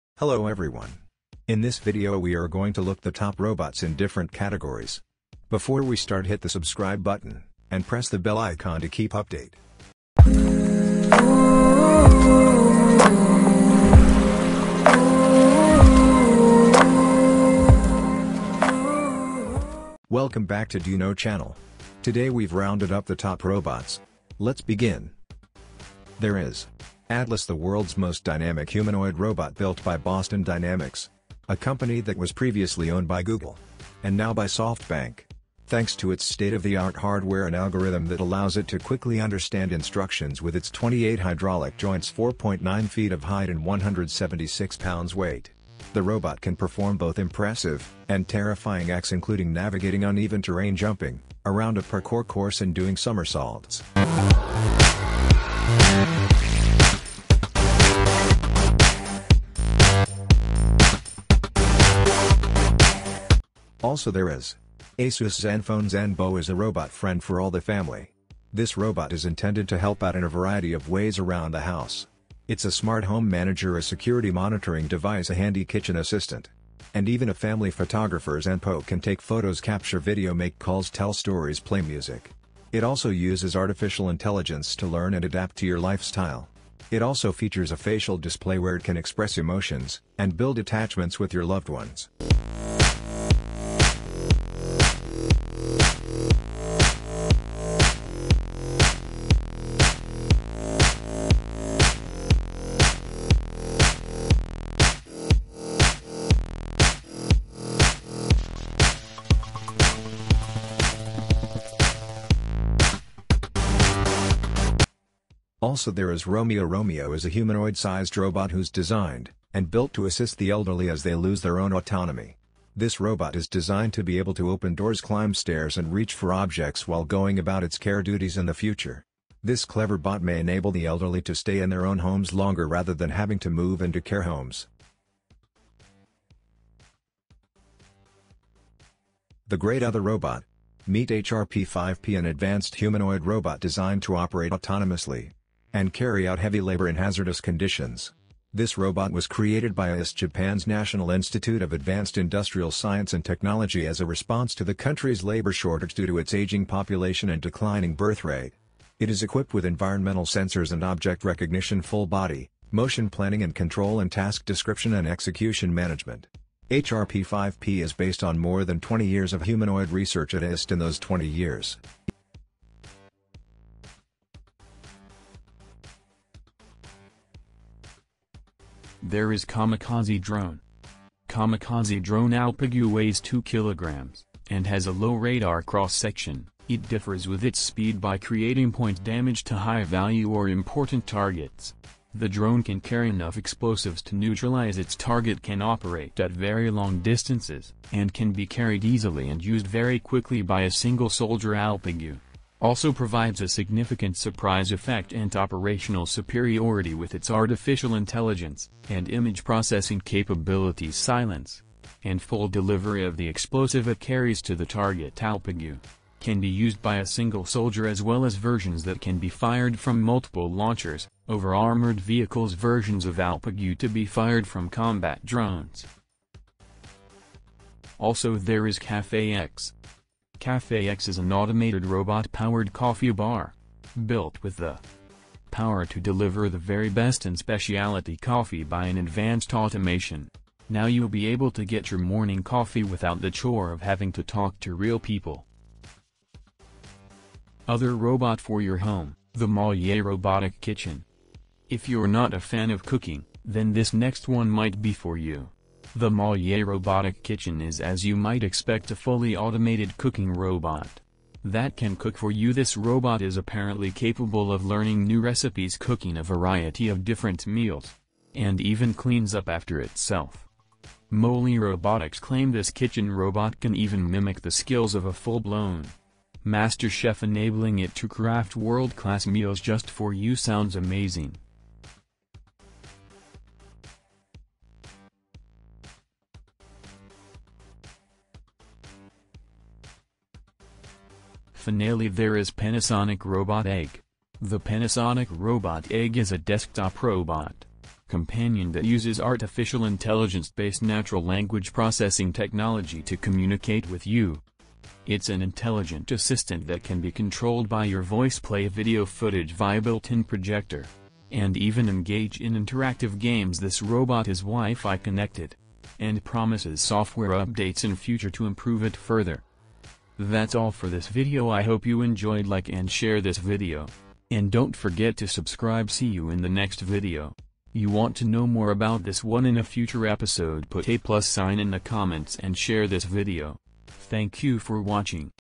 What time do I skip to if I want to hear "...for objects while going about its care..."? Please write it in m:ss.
2:06.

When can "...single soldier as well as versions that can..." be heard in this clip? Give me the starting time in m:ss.
3:37.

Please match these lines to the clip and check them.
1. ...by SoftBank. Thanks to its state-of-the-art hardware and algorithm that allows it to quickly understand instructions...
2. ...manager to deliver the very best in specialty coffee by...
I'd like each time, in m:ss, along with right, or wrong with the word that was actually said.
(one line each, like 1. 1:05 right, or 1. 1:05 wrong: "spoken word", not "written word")
1. 0:34 right
2. 3:55 wrong: "power", not "manager".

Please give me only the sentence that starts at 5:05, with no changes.
It's an intelligent assistant that can be controlled by your voice play video footage via built-in projector.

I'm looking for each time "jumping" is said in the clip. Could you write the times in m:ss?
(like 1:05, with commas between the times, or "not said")
0:50.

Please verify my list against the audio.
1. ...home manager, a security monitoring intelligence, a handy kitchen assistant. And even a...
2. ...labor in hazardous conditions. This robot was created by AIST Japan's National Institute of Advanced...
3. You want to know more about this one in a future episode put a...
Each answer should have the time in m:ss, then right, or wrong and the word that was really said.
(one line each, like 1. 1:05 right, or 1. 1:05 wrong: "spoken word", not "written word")
1. 1:13 wrong: "device", not "intelligence"
2. 2:26 right
3. 5:27 right.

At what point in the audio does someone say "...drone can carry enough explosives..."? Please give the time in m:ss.
3:12.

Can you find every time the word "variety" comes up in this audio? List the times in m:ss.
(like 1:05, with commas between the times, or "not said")
1:10, 4:26.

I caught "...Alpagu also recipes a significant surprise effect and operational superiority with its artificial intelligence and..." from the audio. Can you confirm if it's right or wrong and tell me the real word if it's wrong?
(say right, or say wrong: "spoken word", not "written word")
wrong: "provides", not "recipes".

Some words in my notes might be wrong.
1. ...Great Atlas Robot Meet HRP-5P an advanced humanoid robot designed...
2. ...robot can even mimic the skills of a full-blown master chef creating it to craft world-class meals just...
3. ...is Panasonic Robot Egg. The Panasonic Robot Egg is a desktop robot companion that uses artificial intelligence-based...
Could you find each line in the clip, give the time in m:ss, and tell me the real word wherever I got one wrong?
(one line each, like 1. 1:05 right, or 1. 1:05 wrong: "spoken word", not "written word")
1. 2:19 wrong: "Other", not "Atlas"
2. 4:33 wrong: "enabling", not "creating"
3. 4:52 right.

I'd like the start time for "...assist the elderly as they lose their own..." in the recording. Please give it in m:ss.
2:00.